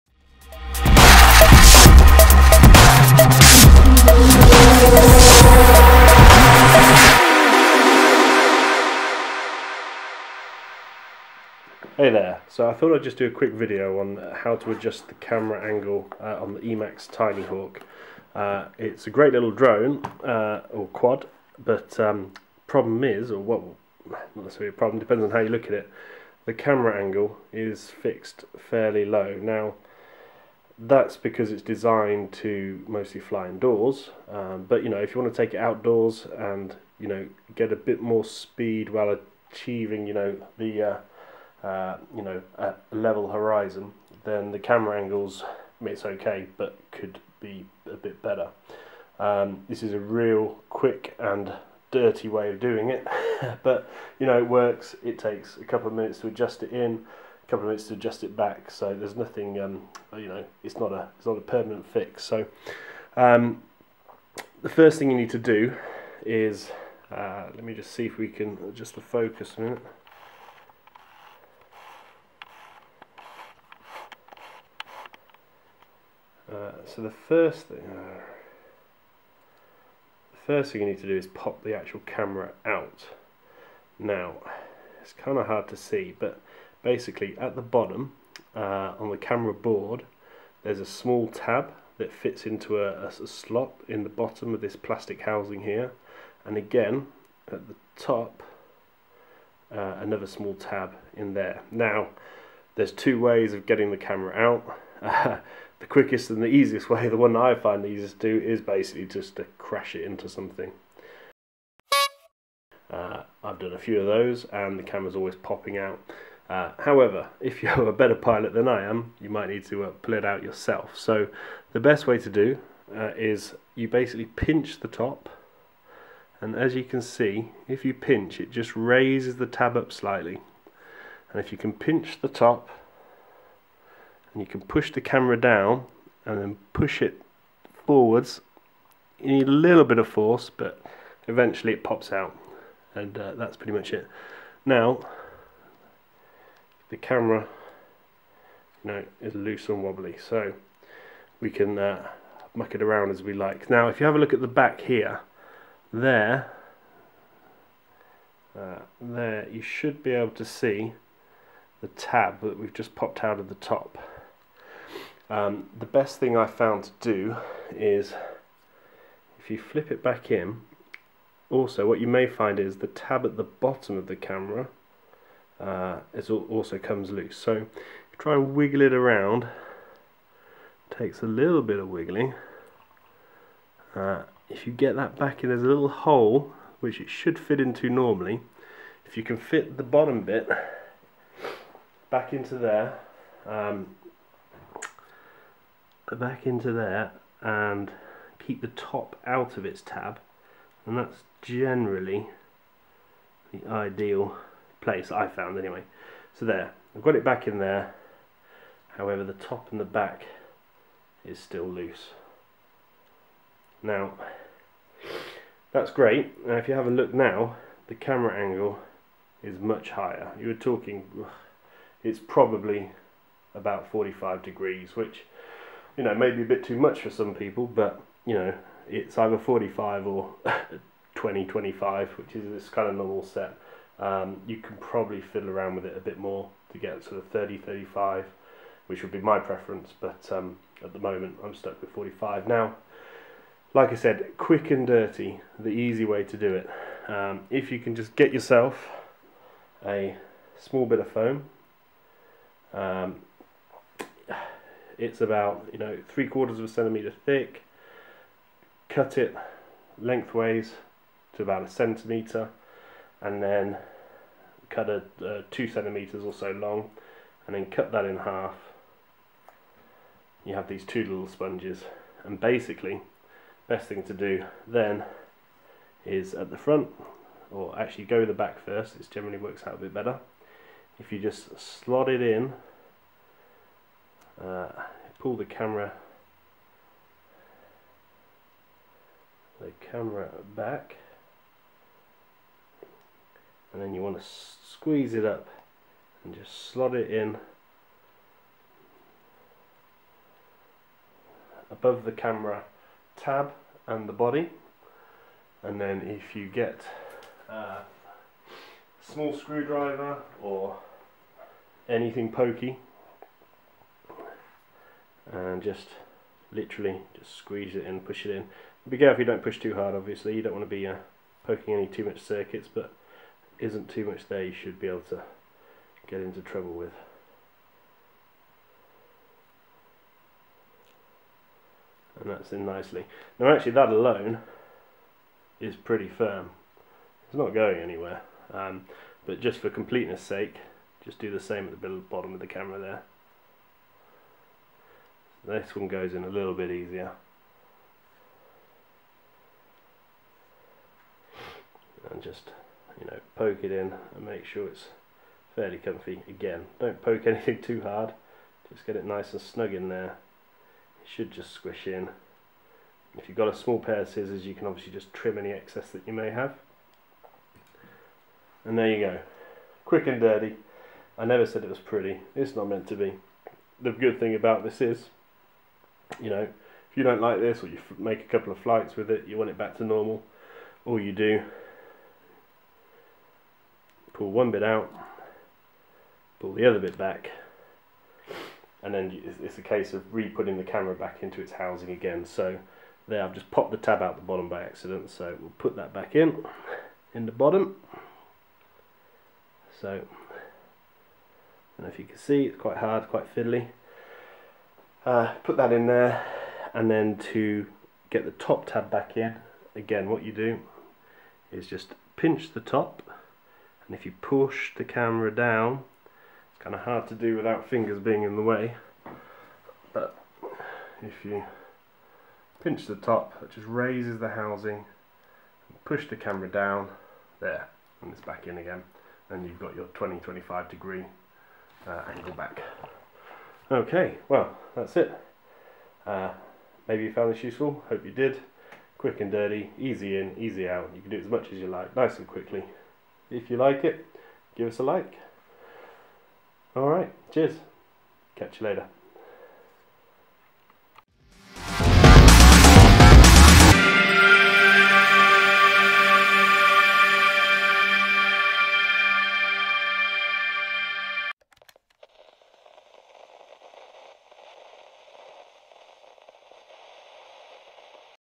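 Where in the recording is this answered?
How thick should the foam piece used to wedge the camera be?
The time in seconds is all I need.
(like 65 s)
256 s.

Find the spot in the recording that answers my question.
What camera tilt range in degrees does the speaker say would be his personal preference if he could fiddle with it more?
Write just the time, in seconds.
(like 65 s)
237 s.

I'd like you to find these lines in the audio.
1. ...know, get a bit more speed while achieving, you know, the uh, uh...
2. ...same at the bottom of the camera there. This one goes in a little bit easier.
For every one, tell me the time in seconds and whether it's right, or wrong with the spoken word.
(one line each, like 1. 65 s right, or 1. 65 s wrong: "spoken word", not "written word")
1. 37 s right
2. 341 s right.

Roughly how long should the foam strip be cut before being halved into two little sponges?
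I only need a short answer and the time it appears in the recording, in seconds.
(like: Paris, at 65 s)
2 centimeters, at 265 s.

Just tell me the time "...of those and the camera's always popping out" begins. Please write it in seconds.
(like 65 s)
113 s.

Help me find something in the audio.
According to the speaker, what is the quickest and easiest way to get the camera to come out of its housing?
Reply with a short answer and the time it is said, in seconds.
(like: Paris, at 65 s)
crash it into something, at 109 s.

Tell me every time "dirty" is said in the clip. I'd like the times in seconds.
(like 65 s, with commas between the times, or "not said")
51 s, 244 s, 370 s, 439 s.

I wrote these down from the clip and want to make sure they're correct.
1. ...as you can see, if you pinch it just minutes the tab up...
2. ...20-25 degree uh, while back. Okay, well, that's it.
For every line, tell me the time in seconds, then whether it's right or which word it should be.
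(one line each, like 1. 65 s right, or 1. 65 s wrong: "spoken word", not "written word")
1. 126 s wrong: "raises", not "minutes"
2. 429 s wrong: "angle", not "while".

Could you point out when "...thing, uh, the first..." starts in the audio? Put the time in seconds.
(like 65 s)
77 s.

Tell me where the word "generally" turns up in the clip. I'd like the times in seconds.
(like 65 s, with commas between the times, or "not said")
201 s, 279 s.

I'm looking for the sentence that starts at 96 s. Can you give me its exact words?
And again, at the top, uh, another small tab in there.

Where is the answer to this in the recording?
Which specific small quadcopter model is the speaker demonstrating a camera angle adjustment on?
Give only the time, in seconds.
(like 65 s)
16 s.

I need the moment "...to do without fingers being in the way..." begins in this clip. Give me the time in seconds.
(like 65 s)
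417 s.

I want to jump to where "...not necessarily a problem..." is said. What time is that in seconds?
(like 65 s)
24 s.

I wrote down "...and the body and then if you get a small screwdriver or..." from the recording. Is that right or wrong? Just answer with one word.
right.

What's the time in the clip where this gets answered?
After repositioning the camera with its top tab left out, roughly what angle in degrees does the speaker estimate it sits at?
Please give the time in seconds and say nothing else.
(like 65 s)
223 s.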